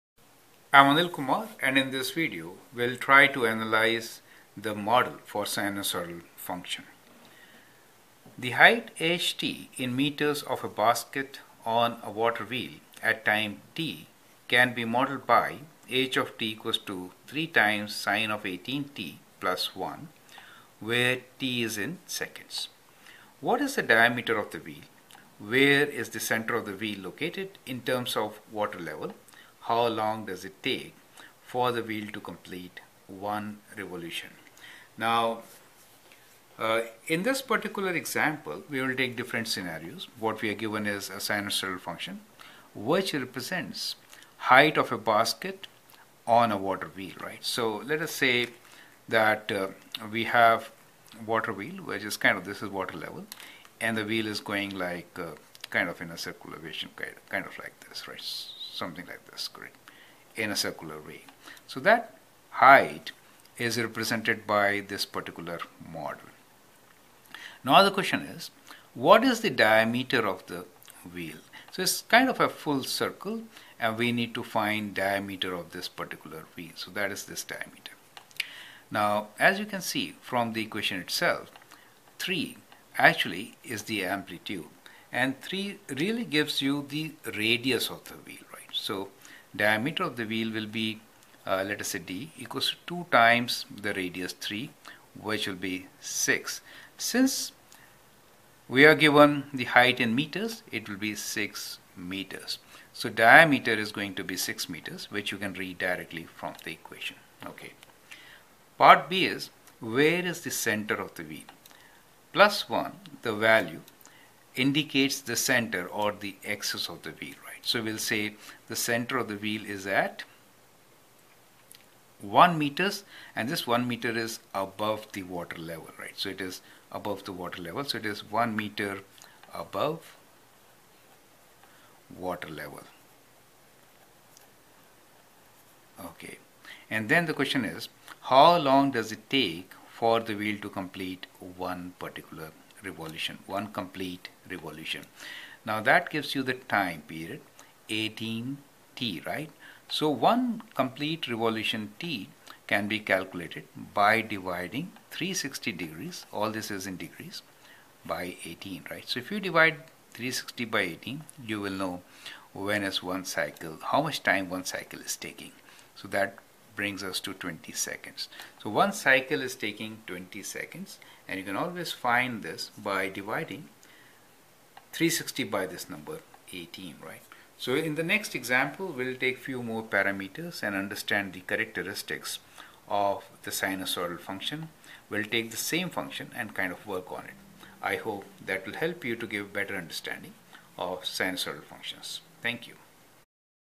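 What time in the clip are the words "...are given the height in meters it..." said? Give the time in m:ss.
1:38.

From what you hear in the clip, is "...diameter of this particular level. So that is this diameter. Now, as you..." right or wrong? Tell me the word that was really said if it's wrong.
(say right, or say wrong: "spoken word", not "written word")
wrong: "wheel", not "level".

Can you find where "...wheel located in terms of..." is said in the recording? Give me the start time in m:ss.
0:26.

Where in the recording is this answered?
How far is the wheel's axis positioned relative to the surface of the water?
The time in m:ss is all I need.
2:08.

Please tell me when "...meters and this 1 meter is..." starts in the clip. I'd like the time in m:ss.
2:02.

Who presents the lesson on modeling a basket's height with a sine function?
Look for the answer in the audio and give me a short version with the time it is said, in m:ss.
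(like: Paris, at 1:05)
Anil Kumar, at 0:00.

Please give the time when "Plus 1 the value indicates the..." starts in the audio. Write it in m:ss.
1:52.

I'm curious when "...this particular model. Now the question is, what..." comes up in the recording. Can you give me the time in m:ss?
1:04.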